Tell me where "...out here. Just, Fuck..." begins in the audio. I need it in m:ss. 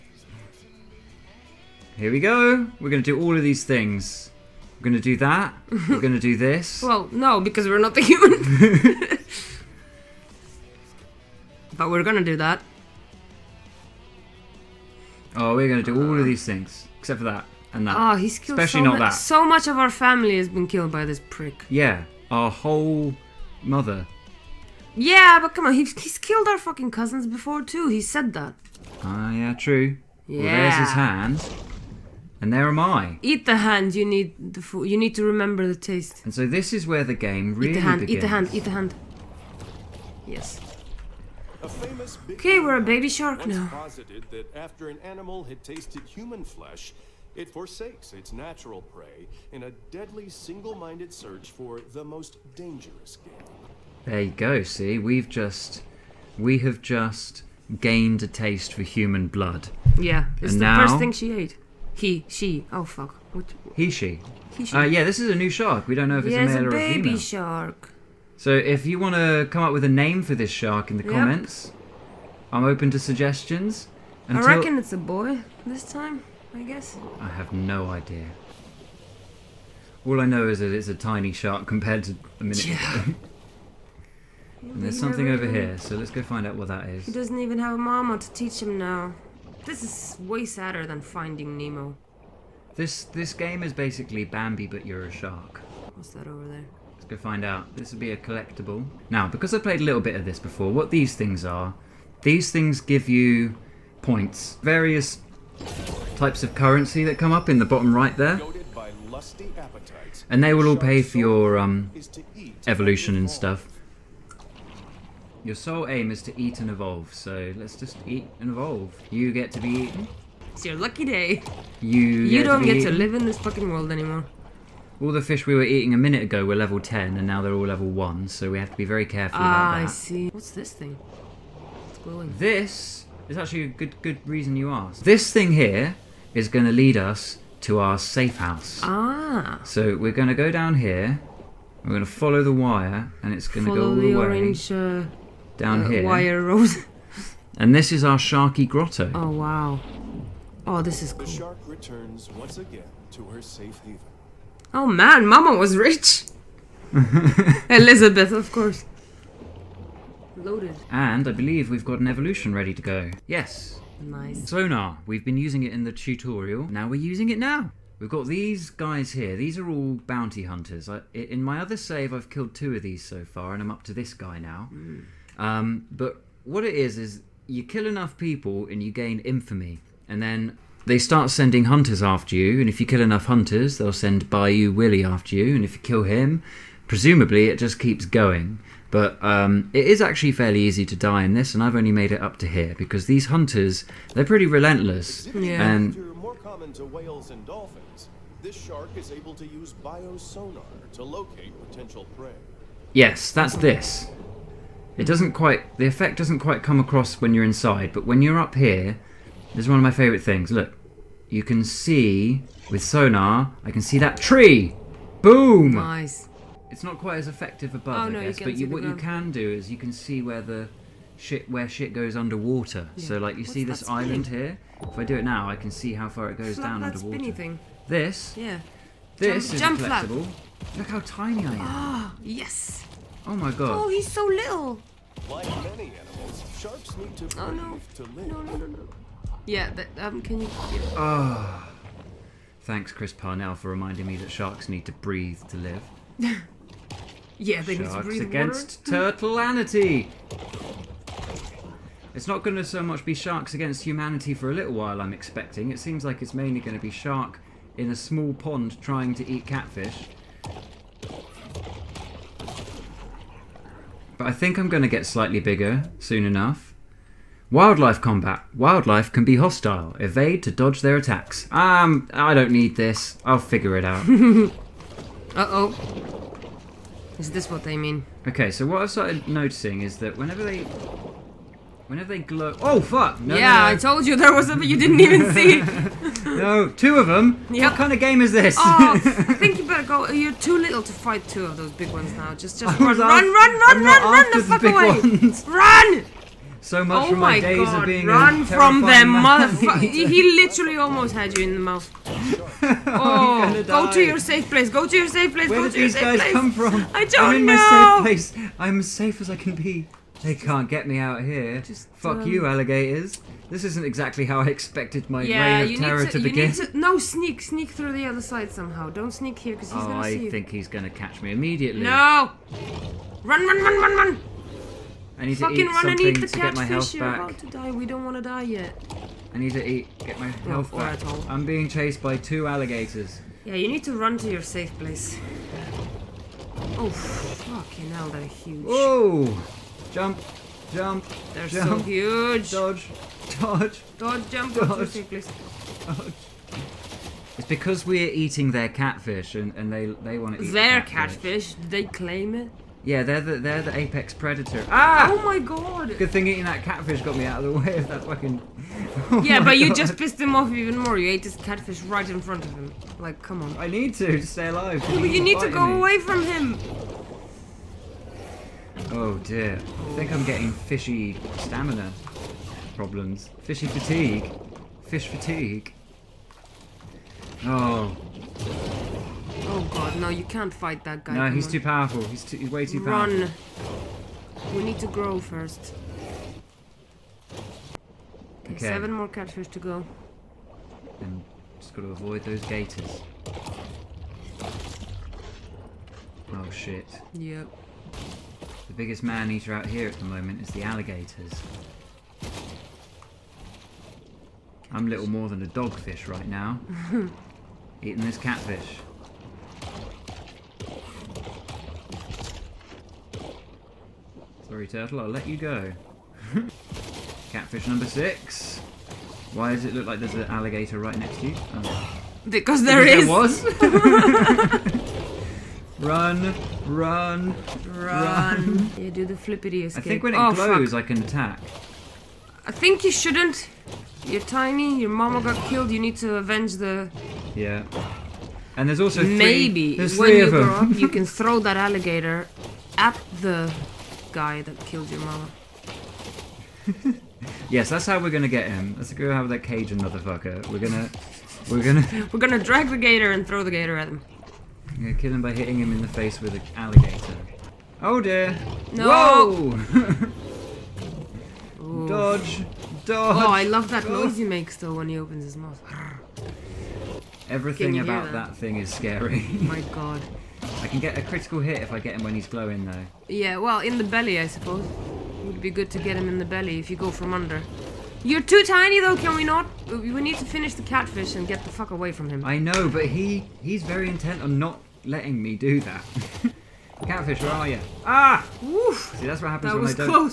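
5:10.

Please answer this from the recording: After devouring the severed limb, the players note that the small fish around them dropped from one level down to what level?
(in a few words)
1.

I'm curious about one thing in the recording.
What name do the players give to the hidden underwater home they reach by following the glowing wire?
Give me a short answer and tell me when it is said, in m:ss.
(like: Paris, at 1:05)
Sharky Grotto, at 2:28.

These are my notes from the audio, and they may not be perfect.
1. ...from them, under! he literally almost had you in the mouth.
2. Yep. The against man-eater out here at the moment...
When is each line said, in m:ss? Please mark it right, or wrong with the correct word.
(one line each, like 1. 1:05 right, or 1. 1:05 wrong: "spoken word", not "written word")
1. 4:58 wrong: "motherfucker", not "under"
2. 6:37 wrong: "biggest", not "against".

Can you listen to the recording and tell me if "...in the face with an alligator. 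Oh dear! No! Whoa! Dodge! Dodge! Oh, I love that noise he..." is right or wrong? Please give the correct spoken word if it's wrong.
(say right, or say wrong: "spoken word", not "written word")
right.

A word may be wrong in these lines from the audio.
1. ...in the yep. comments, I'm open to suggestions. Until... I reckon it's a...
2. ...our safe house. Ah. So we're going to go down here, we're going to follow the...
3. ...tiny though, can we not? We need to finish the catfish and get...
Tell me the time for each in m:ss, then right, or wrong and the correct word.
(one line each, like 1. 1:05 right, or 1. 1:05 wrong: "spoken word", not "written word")
1. 1:10 right
2. 2:17 right
3. 7:58 right.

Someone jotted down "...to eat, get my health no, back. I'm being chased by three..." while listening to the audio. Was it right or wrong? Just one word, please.
wrong.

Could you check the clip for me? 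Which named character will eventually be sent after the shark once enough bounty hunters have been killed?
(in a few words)
Bayou Willie.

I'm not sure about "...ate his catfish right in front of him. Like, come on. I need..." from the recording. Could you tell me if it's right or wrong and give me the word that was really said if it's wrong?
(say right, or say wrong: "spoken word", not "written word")
right.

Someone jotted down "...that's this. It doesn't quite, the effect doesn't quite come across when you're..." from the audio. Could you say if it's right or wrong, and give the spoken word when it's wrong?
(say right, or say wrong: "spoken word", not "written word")
right.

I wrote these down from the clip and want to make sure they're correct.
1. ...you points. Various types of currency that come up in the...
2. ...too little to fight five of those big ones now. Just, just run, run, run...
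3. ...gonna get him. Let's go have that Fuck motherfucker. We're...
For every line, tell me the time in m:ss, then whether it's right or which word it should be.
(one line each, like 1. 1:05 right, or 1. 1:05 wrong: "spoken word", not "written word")
1. 1:43 right
2. 4:50 wrong: "two", not "five"
3. 7:28 wrong: "Cajun", not "Fuck".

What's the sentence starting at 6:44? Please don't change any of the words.
I'm little more than a dogfish right now.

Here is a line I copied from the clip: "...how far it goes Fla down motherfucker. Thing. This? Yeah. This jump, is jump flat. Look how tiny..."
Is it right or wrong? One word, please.
wrong.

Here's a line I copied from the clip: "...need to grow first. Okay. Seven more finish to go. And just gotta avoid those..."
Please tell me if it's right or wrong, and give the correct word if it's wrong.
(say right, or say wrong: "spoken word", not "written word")
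wrong: "catfish", not "finish".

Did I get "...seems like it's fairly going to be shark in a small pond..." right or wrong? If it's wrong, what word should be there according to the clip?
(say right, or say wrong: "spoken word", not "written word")
wrong: "mainly", not "fairly".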